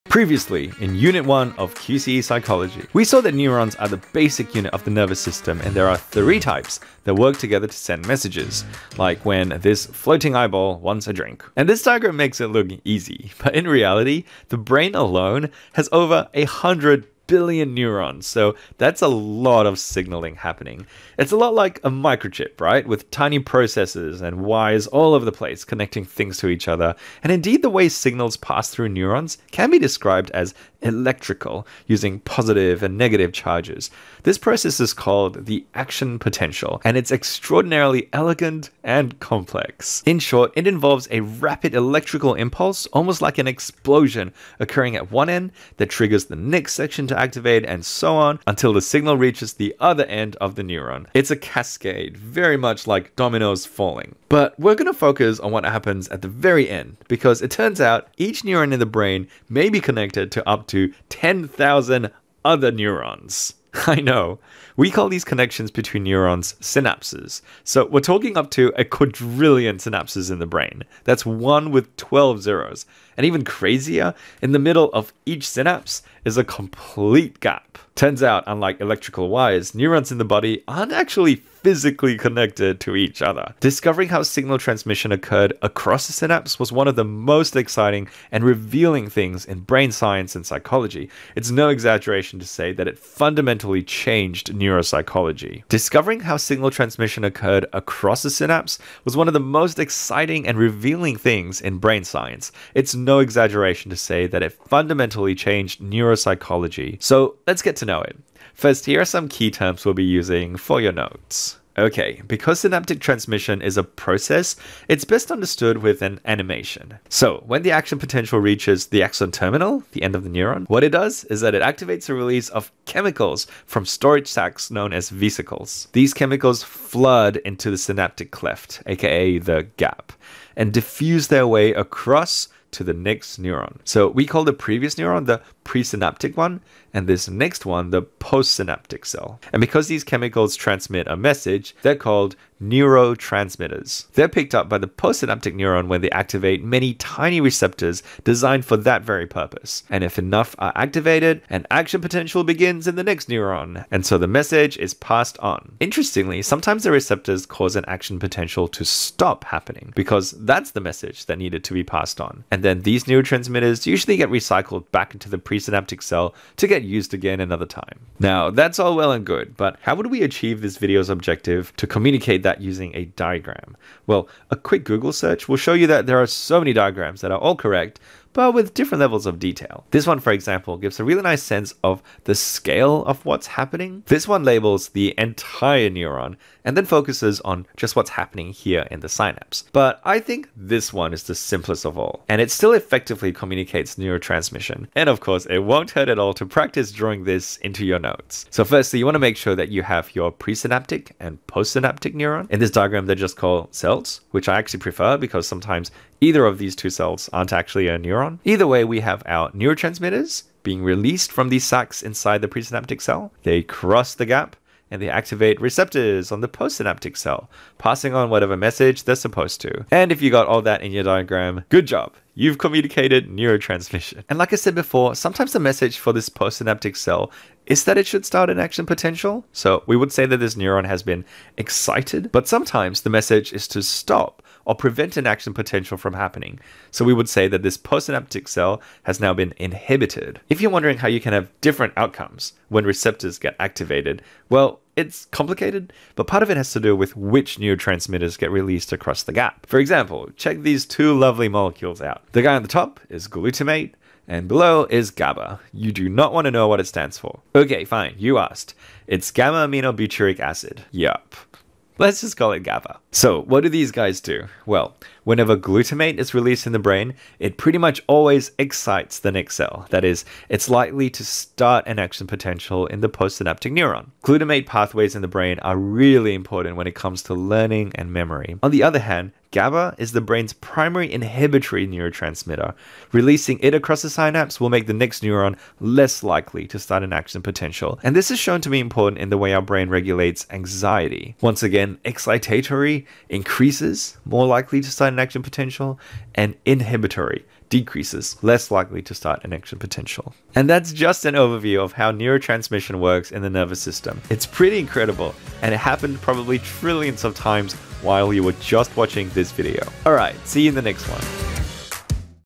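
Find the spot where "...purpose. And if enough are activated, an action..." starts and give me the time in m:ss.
2:29.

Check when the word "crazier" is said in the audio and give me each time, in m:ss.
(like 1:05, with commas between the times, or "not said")
1:13.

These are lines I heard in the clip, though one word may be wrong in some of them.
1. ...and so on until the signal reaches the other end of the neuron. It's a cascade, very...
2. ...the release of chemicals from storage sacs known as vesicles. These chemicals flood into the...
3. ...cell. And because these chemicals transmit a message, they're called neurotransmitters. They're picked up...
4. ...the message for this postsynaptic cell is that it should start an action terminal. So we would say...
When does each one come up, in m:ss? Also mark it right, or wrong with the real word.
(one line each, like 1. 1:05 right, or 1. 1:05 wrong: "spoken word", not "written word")
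1. 0:47 right
2. 2:02 right
3. 2:19 right
4. 3:45 wrong: "potential", not "terminal".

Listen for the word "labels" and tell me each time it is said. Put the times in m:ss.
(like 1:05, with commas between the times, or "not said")
3:04.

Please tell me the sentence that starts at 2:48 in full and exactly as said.
Now, that's all well and good, but how would we achieve this video's objective to communicate that using a diagram?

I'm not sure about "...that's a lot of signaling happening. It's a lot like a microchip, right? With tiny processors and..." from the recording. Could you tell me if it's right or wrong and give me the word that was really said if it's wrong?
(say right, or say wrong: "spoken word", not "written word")
right.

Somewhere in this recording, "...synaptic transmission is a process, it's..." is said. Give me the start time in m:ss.
1:52.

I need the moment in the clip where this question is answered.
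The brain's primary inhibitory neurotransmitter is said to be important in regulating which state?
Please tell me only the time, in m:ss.
4:50.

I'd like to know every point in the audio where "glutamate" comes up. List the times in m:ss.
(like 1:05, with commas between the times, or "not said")
4:13, 4:25, 4:34.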